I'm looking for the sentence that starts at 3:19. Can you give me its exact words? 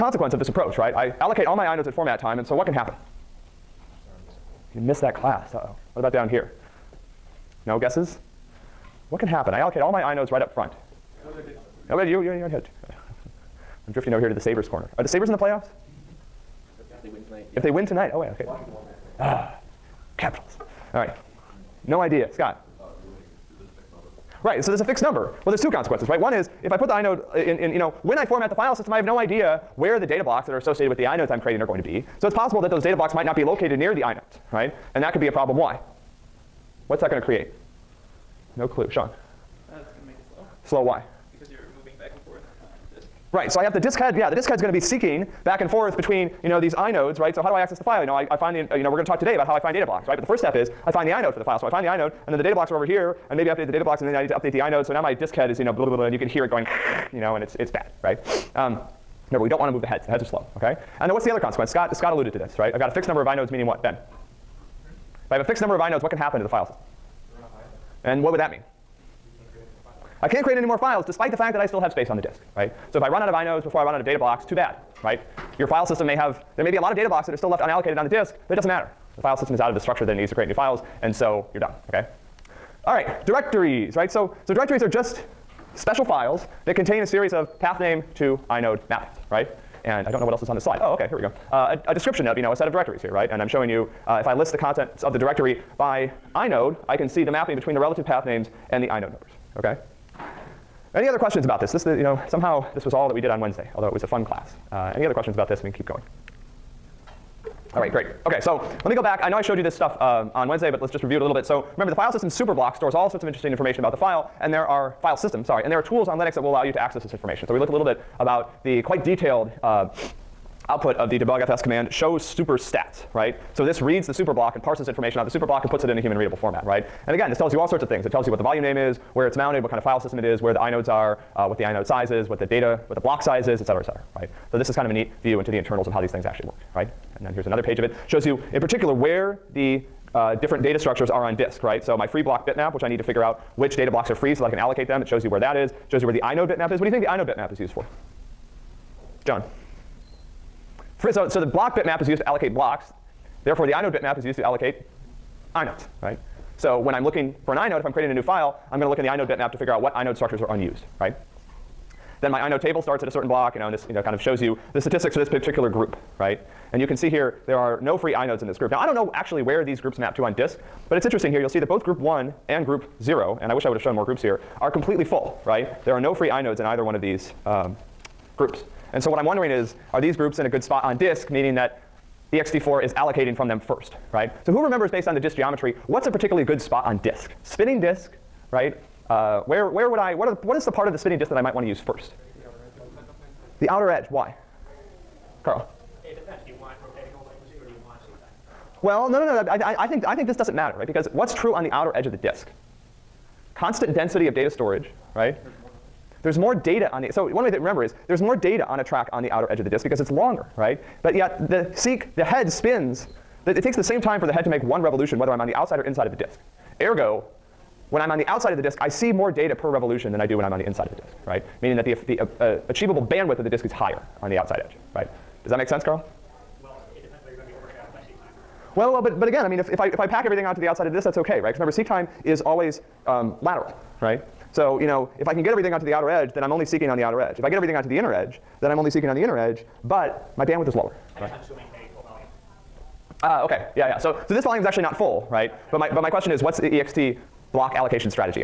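I, I, I, think, I think this doesn't matter, right?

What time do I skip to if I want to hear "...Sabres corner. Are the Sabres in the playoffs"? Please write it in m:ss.
0:14.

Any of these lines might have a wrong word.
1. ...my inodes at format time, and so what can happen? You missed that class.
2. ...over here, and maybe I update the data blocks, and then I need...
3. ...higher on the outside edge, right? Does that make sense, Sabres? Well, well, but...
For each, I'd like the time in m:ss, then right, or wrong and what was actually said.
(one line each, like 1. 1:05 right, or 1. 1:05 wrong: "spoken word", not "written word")
1. 0:01 right
2. 0:52 right
3. 3:43 wrong: "Carl", not "Sabres".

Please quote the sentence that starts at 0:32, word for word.
So it's possible that those data blocks might not be located near the inode, right?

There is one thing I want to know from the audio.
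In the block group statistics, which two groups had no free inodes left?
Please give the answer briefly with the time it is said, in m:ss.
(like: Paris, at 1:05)
group 1 and group 0, at 2:51.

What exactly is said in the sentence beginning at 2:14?
So this is kind of a neat view into the internals of how these things actually work, right?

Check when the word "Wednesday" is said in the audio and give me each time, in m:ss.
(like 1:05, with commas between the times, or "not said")
1:43, 1:50.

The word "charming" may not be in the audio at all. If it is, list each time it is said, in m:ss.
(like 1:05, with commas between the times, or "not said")
not said.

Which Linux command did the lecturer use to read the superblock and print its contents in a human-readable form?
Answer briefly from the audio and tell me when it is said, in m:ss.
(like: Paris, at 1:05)
debugfs, at 2:01.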